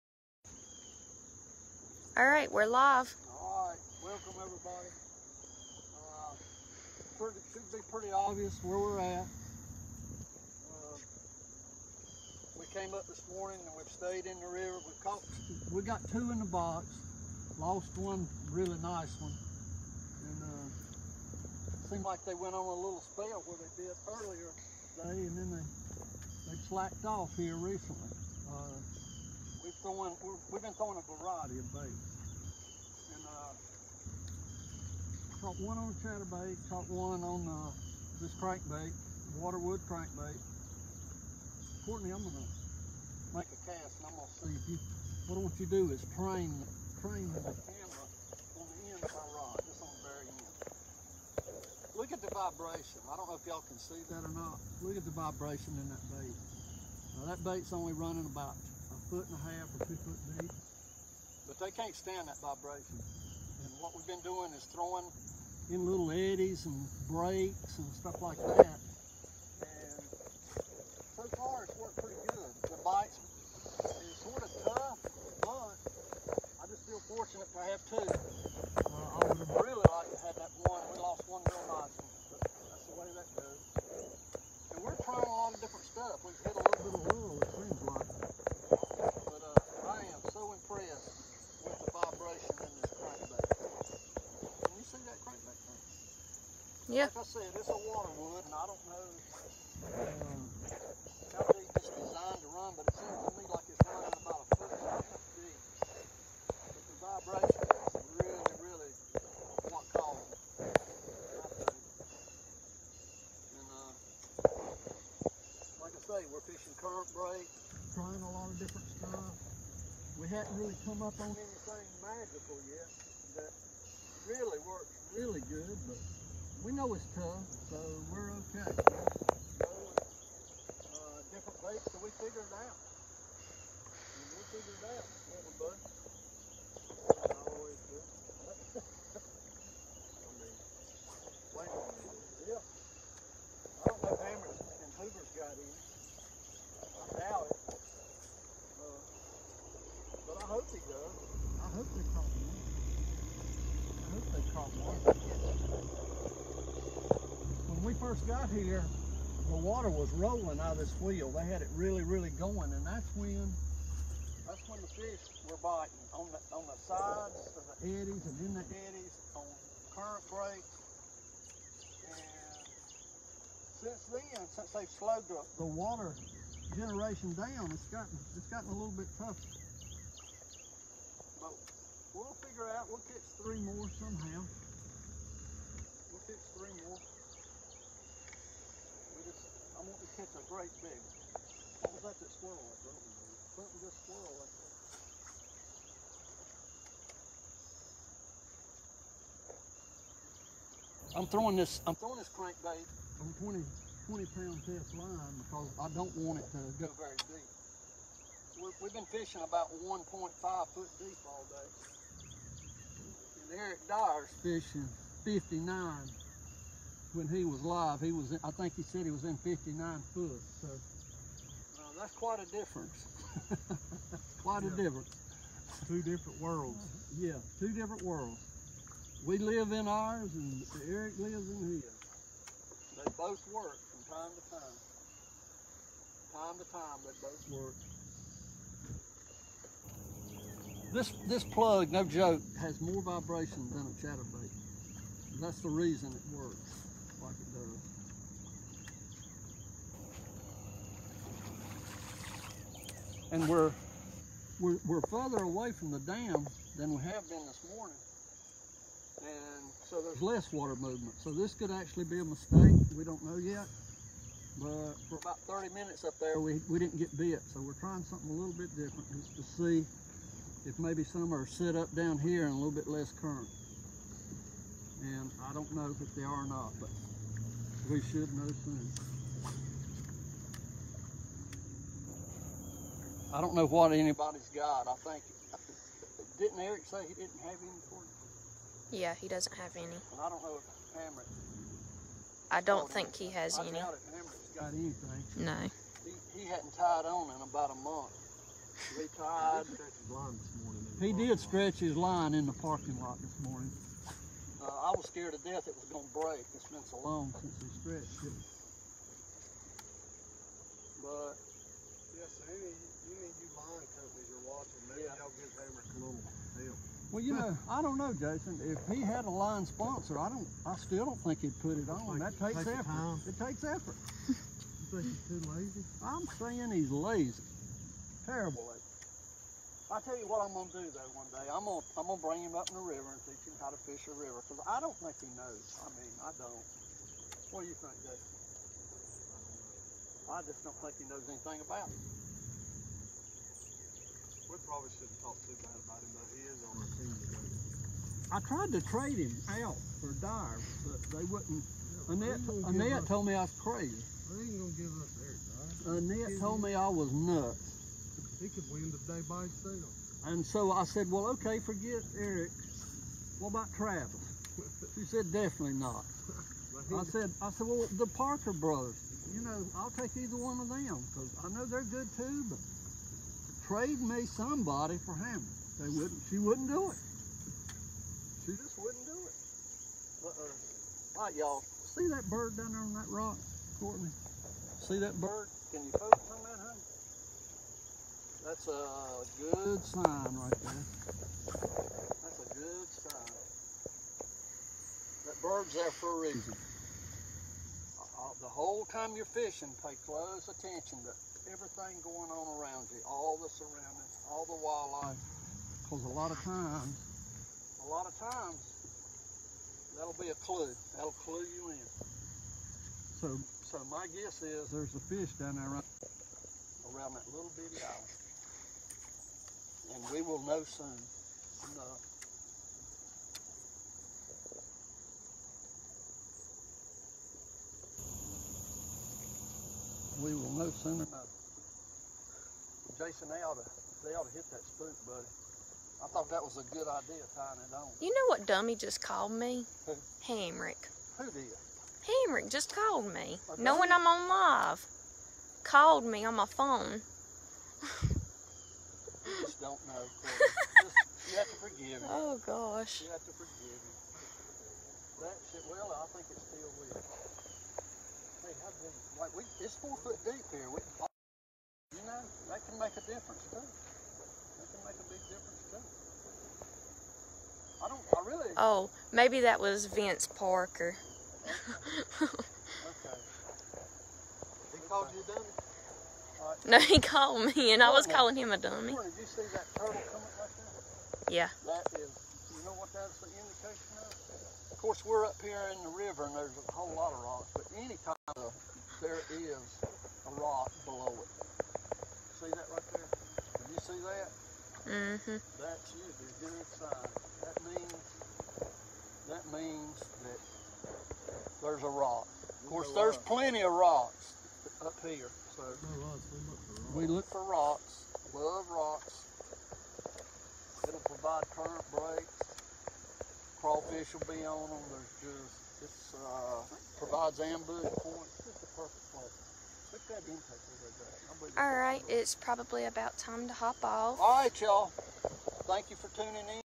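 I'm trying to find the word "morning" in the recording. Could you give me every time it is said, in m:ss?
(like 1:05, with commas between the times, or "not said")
0:13, 4:17, 5:03.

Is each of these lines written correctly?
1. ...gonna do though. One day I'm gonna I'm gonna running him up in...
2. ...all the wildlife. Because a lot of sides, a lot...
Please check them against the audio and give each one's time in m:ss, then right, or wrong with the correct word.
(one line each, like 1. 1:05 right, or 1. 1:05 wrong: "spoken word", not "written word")
1. 5:30 wrong: "bring", not "running"
2. 6:44 wrong: "times", not "sides".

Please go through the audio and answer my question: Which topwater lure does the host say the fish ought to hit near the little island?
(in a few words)
spook.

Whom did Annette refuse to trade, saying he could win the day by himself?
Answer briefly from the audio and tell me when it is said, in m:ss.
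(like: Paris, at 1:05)
Dive, at 5:50.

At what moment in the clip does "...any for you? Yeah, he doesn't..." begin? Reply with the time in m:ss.
4:47.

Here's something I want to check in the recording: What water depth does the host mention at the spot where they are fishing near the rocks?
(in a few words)
4 feet.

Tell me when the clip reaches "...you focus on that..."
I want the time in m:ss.
6:25.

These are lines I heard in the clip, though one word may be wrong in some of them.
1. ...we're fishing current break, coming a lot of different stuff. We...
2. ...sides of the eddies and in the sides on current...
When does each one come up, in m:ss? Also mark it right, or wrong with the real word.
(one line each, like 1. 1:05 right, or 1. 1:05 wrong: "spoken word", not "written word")
1. 1:56 wrong: "trying", not "coming"
2. 2:46 wrong: "eddies", not "sides".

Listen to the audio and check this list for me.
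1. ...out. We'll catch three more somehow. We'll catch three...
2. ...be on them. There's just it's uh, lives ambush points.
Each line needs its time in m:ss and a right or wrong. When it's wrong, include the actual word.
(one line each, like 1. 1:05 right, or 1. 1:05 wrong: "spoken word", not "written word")
1. 3:02 right
2. 8:34 wrong: "provides", not "lives".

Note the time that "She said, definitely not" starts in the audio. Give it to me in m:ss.
6:04.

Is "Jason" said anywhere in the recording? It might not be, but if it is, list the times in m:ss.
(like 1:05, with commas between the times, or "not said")
5:18, 5:38, 7:12.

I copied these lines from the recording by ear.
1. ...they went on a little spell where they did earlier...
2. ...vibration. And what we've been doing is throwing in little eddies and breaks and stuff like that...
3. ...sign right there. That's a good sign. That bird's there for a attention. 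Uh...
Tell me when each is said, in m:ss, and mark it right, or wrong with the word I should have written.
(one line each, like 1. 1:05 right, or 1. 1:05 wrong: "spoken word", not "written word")
1. 0:22 right
2. 1:02 right
3. 6:29 wrong: "reason", not "attention".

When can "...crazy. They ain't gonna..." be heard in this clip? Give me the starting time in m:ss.
5:53.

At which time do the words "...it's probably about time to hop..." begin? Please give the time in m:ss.
8:42.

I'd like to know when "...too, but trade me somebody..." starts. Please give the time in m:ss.
6:12.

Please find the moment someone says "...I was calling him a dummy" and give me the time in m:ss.
7:57.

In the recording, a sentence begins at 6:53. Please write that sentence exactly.
So, so my guess is there's a fish down there around, around that little bitty island.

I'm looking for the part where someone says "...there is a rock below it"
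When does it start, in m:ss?
8:09.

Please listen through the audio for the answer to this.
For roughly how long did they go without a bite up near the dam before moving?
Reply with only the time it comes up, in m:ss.
4:25.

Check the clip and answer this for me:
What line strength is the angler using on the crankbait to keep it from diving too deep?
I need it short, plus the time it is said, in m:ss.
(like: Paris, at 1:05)
20 pound, at 3:24.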